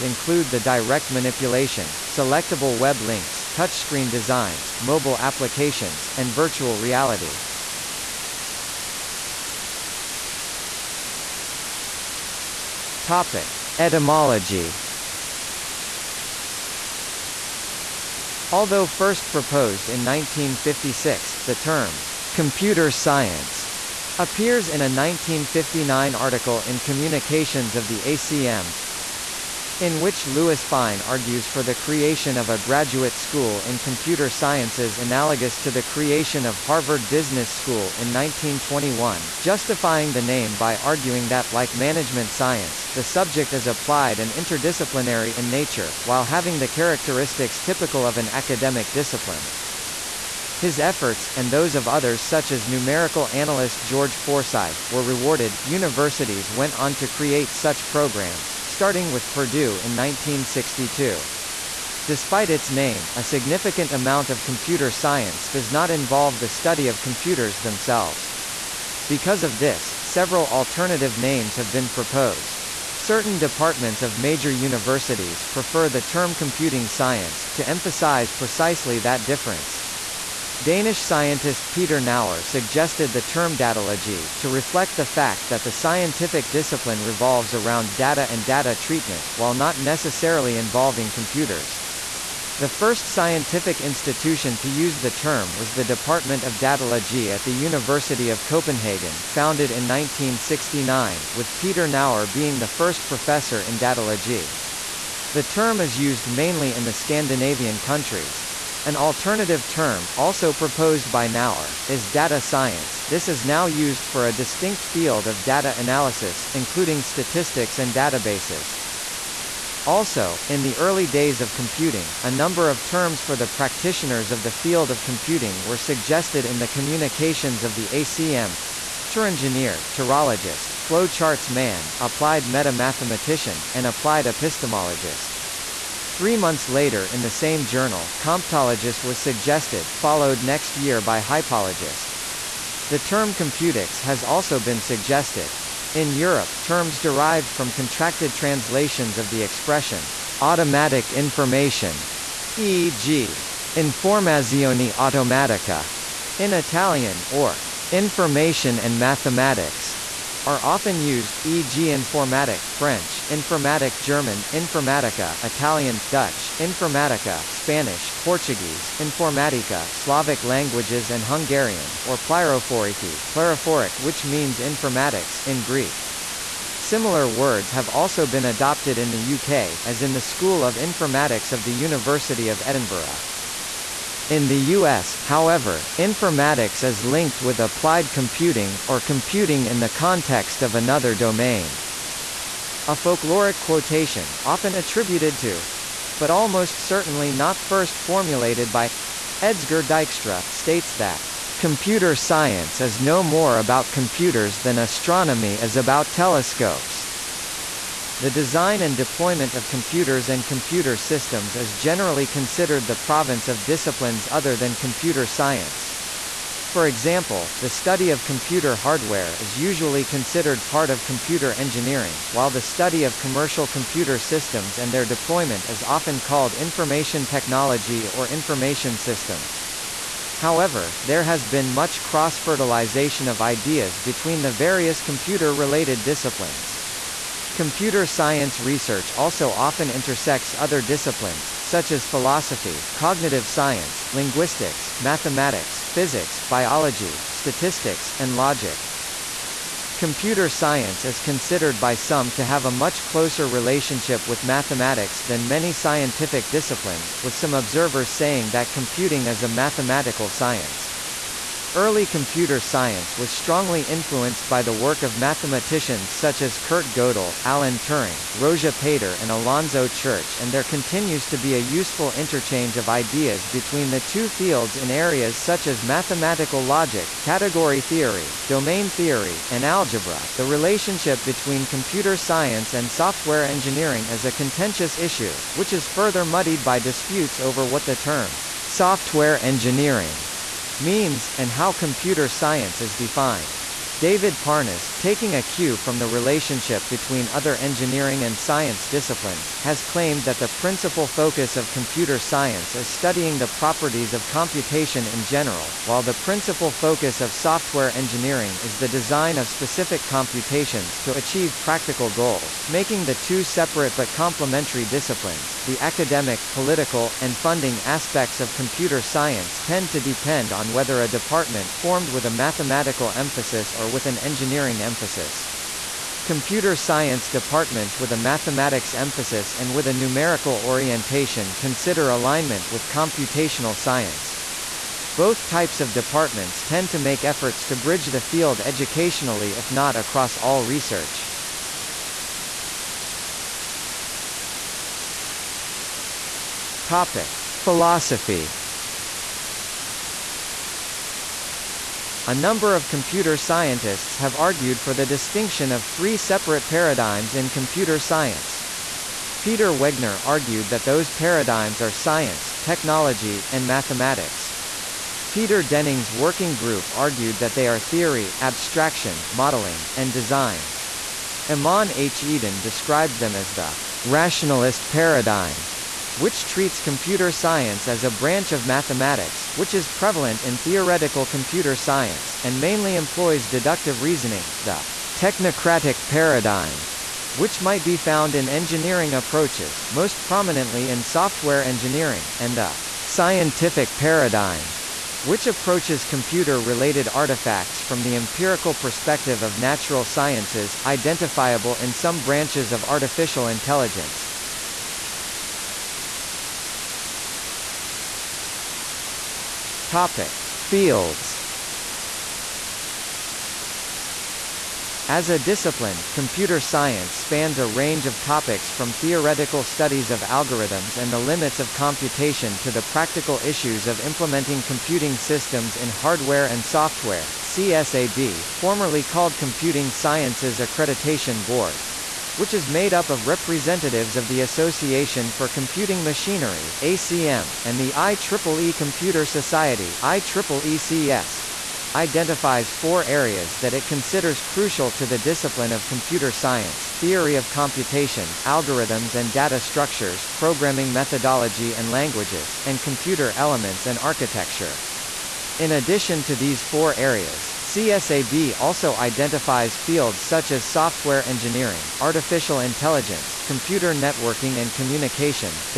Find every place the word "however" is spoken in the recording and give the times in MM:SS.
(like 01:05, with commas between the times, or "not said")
03:05, 03:50.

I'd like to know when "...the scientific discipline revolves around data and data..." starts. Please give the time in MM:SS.
01:25.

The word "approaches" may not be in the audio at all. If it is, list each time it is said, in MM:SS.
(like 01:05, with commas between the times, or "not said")
06:29, 06:35.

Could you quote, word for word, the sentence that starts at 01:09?
Because of this, several alternative names have been proposed.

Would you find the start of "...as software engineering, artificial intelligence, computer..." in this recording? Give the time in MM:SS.
07:40.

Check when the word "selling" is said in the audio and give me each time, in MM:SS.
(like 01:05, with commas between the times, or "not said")
not said.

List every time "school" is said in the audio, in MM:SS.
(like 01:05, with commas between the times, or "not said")
00:33, 00:37, 03:00.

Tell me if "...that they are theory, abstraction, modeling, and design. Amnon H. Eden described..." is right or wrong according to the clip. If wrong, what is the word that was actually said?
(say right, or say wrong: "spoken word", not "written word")
right.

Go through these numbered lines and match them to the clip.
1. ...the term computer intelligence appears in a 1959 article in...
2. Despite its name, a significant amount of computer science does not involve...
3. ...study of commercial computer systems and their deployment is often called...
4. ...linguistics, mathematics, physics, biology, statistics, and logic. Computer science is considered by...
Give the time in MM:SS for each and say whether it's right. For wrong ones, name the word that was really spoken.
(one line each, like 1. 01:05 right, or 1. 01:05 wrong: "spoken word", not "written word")
1. 00:21 wrong: "science", not "intelligence"
2. 01:02 right
3. 03:42 right
4. 04:04 right.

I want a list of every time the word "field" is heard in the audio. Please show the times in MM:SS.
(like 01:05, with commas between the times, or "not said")
01:54, 02:04, 04:34, 05:38, 06:50, 07:39.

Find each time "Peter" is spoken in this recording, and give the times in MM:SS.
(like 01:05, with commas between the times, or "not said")
01:21, 01:41, 05:59, 06:05.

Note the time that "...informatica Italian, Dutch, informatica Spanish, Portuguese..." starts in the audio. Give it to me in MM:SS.
02:44.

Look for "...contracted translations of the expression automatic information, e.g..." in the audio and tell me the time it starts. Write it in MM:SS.
02:27.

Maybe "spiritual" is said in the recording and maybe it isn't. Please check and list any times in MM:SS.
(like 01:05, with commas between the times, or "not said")
not said.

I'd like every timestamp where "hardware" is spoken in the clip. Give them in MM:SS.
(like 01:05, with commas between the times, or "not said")
03:38, 07:05.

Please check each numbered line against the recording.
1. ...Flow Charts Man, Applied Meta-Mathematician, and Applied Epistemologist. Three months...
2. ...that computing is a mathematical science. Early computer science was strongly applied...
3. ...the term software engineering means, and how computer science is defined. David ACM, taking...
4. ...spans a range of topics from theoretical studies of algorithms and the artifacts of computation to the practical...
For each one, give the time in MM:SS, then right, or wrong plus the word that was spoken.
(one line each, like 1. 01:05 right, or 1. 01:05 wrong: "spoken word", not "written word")
1. 02:10 right
2. 04:18 wrong: "influenced", not "applied"
3. 04:47 wrong: "Parnas", not "ACM"
4. 06:57 wrong: "limits", not "artifacts".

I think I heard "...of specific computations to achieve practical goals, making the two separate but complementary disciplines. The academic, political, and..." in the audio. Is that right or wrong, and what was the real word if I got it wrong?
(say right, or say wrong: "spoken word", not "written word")
right.